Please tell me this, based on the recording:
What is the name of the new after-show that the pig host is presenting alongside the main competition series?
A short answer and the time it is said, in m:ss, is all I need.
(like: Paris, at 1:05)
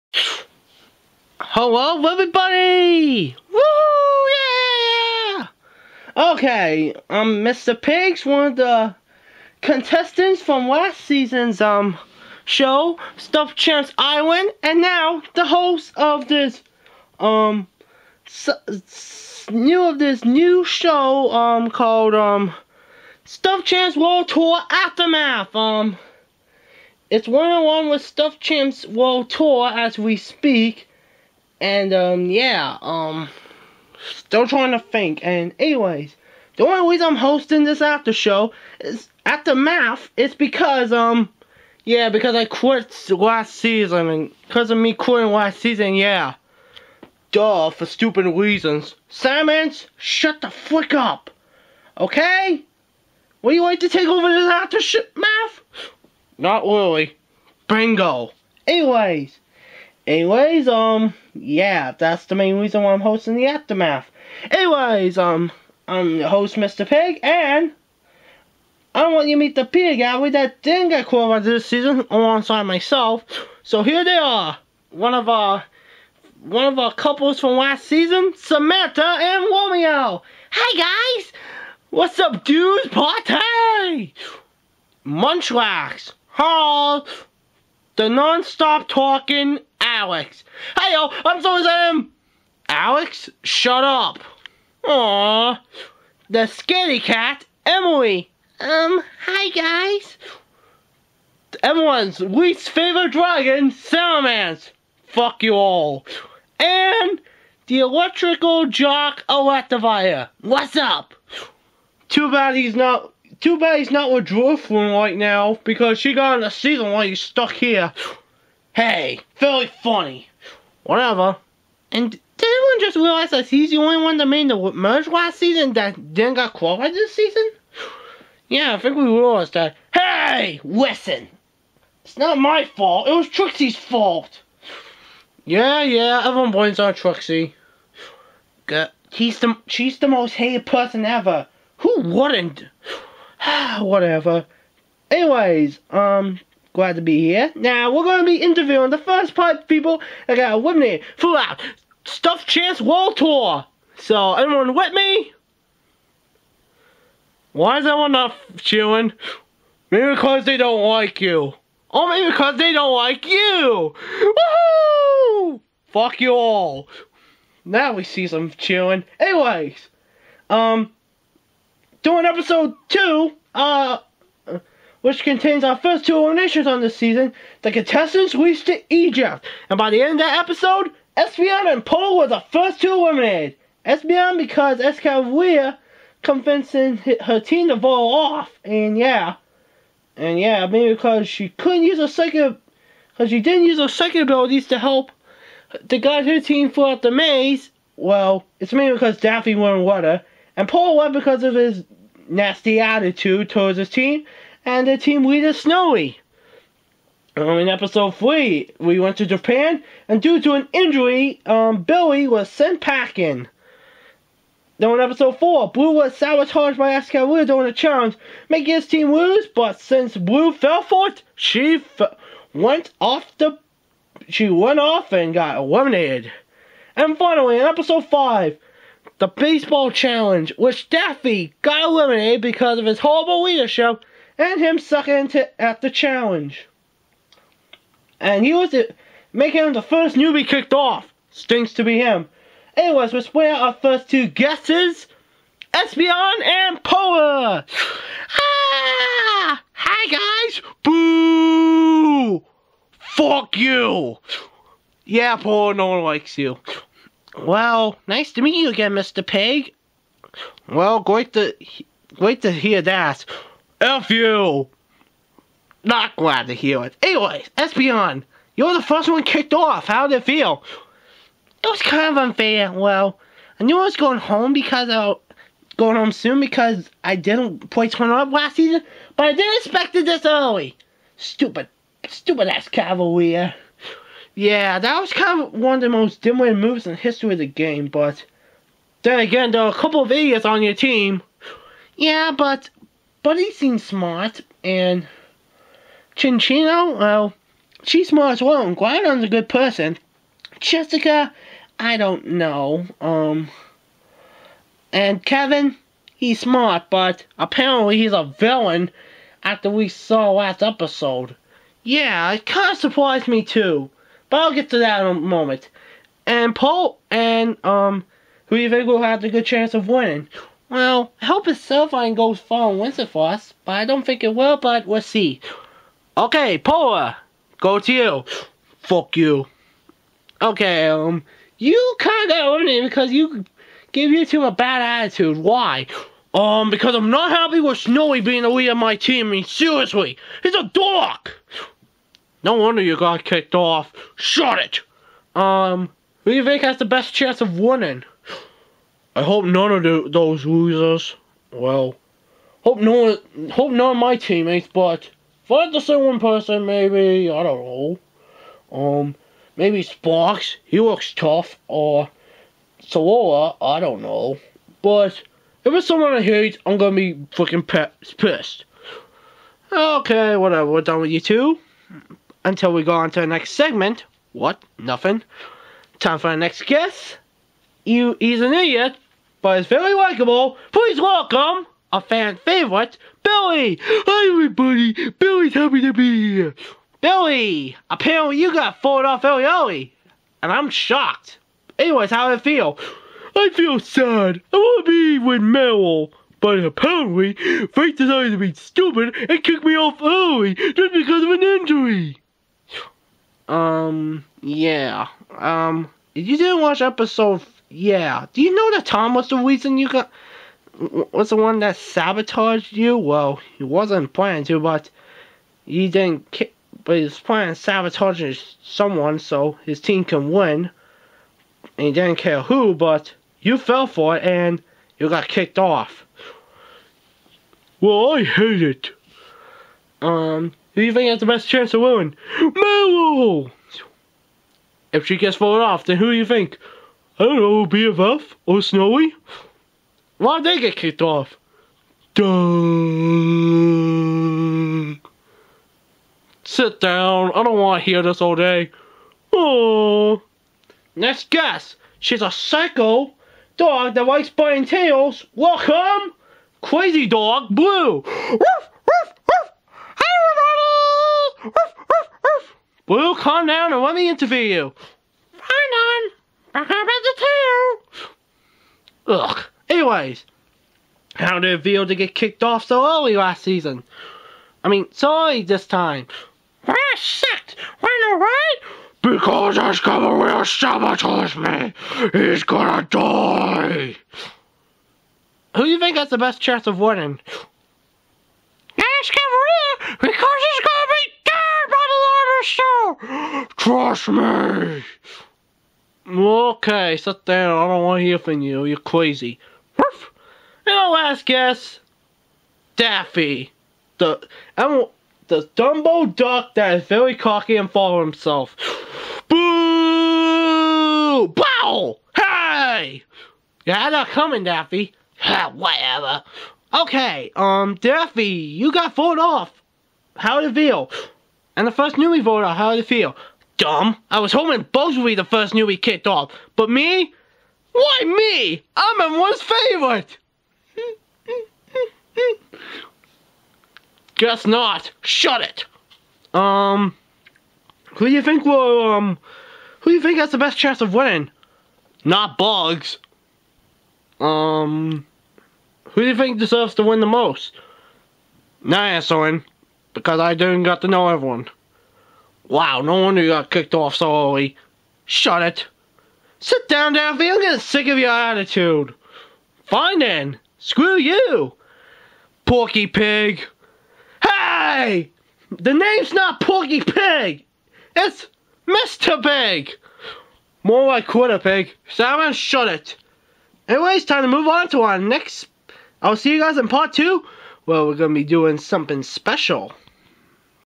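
Stuffed Champs World Tour Aftermath, at 0:23.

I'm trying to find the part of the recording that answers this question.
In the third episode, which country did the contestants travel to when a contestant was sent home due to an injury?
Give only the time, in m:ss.
3:29.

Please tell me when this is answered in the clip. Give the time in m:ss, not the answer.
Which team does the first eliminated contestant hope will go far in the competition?
5:22.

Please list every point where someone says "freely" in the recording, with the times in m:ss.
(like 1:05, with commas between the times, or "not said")
not said.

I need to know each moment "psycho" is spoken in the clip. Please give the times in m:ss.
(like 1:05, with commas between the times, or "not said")
7:32.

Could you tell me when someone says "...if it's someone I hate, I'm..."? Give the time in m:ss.
6:05.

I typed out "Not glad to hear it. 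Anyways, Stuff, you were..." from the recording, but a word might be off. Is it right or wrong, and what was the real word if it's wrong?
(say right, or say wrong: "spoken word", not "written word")
wrong: "Espeon", not "Stuff".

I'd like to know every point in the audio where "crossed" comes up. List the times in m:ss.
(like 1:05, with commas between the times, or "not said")
not said.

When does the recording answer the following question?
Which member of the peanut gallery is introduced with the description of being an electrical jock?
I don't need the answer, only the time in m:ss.
1:49.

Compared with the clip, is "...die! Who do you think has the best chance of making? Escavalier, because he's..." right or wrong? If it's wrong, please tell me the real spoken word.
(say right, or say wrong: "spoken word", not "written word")
wrong: "winning", not "making".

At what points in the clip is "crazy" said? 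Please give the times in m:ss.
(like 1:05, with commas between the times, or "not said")
7:36, 8:18.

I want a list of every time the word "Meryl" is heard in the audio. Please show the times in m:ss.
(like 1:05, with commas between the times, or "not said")
6:35, 7:12.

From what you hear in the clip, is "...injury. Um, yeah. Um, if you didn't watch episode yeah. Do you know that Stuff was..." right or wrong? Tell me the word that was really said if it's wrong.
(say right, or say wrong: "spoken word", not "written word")
wrong: "Tom", not "Stuff".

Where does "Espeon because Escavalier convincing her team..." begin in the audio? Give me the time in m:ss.
3:03.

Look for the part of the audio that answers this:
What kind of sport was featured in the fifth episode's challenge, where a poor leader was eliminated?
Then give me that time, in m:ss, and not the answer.
3:49.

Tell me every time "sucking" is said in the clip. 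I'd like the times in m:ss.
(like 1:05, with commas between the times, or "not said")
3:54.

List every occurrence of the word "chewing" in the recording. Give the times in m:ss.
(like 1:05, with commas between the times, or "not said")
2:38, 2:48.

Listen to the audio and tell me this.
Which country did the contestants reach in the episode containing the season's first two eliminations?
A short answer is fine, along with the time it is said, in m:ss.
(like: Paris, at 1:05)
Egypt, at 2:58.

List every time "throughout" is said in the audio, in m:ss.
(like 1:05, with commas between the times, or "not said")
3:16.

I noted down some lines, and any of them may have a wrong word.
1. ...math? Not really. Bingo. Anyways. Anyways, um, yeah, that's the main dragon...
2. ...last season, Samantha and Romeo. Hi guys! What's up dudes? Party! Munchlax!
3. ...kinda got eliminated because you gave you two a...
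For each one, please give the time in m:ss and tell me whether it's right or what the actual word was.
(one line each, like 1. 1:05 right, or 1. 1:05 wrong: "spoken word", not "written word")
1. 0:55 wrong: "reason", not "dragon"
2. 1:17 right
3. 5:31 right.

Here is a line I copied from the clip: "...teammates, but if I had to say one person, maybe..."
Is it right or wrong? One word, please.
right.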